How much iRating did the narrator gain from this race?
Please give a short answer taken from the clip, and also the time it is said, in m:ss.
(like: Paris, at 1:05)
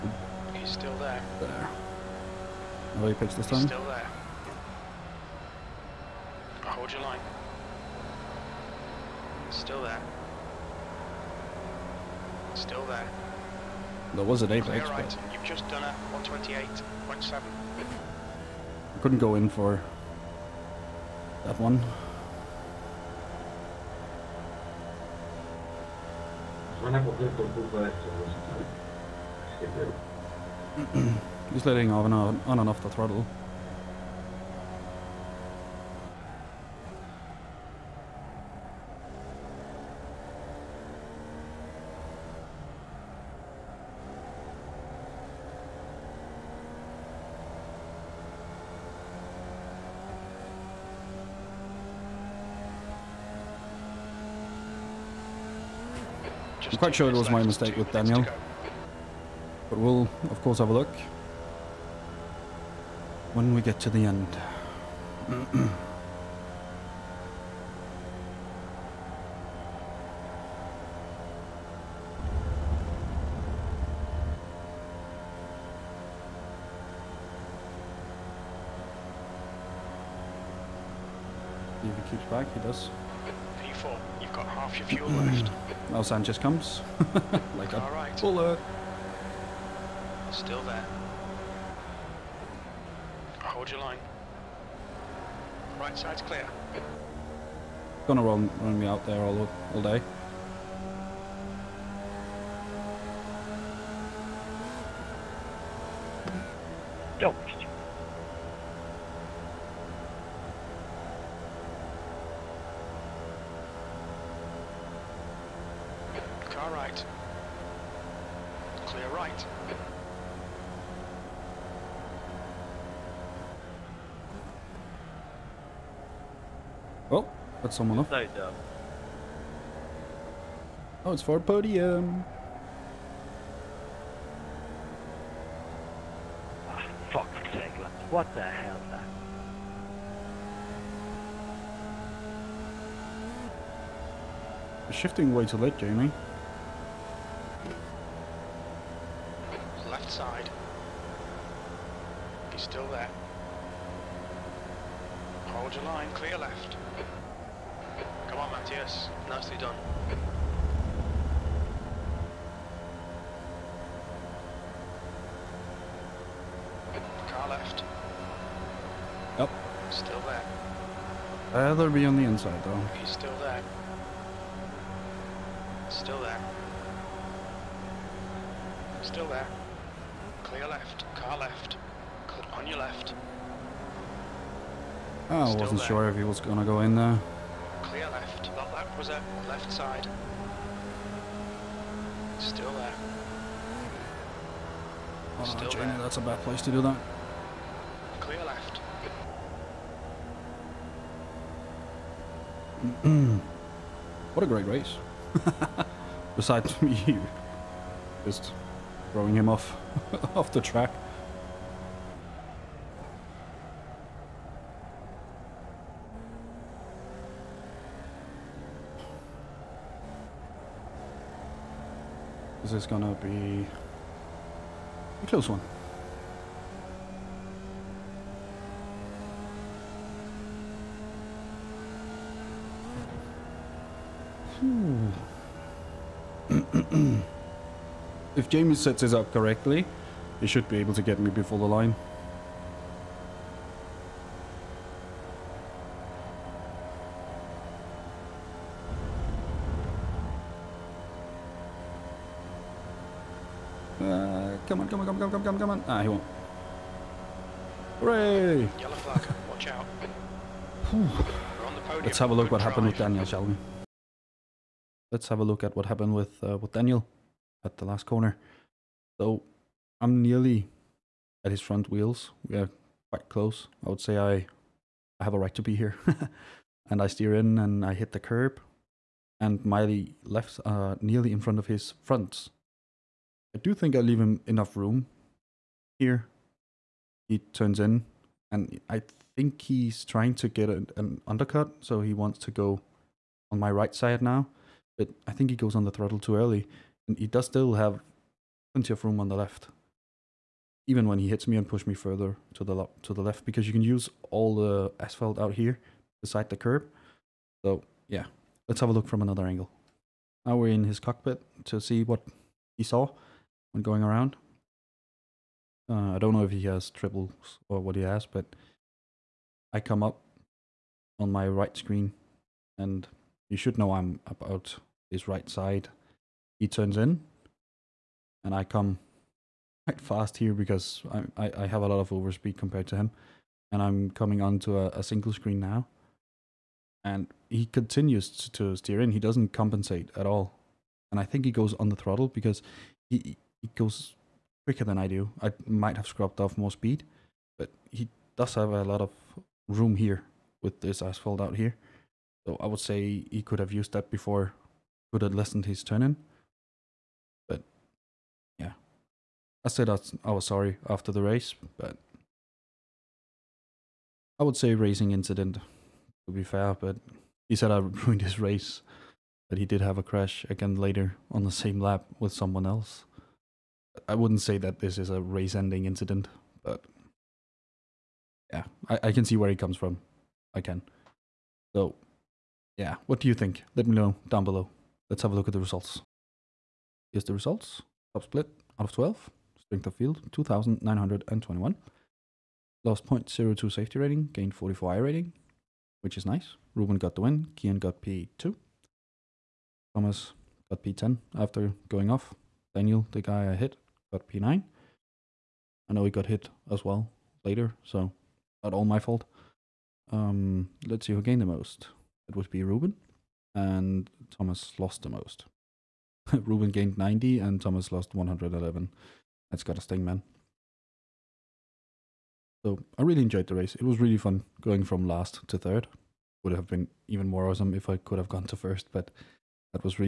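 44, at 6:34.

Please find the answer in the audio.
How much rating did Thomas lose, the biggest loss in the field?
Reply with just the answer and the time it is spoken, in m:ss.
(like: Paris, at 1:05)
111, at 6:58.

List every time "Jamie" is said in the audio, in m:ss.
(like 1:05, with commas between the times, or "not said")
2:25, 3:15, 3:58.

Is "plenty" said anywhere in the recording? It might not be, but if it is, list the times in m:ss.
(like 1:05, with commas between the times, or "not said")
4:58.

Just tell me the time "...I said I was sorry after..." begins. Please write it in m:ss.
5:59.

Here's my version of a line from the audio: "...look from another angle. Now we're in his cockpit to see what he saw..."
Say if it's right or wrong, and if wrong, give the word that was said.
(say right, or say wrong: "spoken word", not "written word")
right.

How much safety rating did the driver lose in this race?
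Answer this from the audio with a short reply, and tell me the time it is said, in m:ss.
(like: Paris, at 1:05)
0.02, at 6:33.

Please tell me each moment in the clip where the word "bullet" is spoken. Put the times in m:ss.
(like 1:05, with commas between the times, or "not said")
1:28.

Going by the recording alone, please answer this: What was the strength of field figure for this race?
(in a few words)
2,921.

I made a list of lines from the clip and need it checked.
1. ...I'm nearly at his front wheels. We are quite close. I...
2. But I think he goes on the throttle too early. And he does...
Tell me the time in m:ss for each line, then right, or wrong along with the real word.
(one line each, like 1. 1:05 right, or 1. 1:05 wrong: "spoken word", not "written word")
1. 4:29 right
2. 4:54 right.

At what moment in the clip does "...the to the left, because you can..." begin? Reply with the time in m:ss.
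5:02.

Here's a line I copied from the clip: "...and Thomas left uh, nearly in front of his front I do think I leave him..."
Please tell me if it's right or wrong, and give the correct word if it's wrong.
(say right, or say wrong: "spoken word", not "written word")
wrong: "Miley", not "Thomas".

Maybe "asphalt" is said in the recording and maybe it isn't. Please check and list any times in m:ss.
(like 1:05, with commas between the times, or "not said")
5:04, 5:50.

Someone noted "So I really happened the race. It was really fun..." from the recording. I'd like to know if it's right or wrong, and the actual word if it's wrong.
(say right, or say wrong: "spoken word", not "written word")
wrong: "enjoyed", not "happened".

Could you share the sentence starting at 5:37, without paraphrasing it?
And he continues to, to steer in.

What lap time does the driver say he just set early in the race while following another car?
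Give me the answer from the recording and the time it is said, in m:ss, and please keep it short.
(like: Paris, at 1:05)
128.7, at 0:16.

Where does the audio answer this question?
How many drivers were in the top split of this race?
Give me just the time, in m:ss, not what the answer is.
6:28.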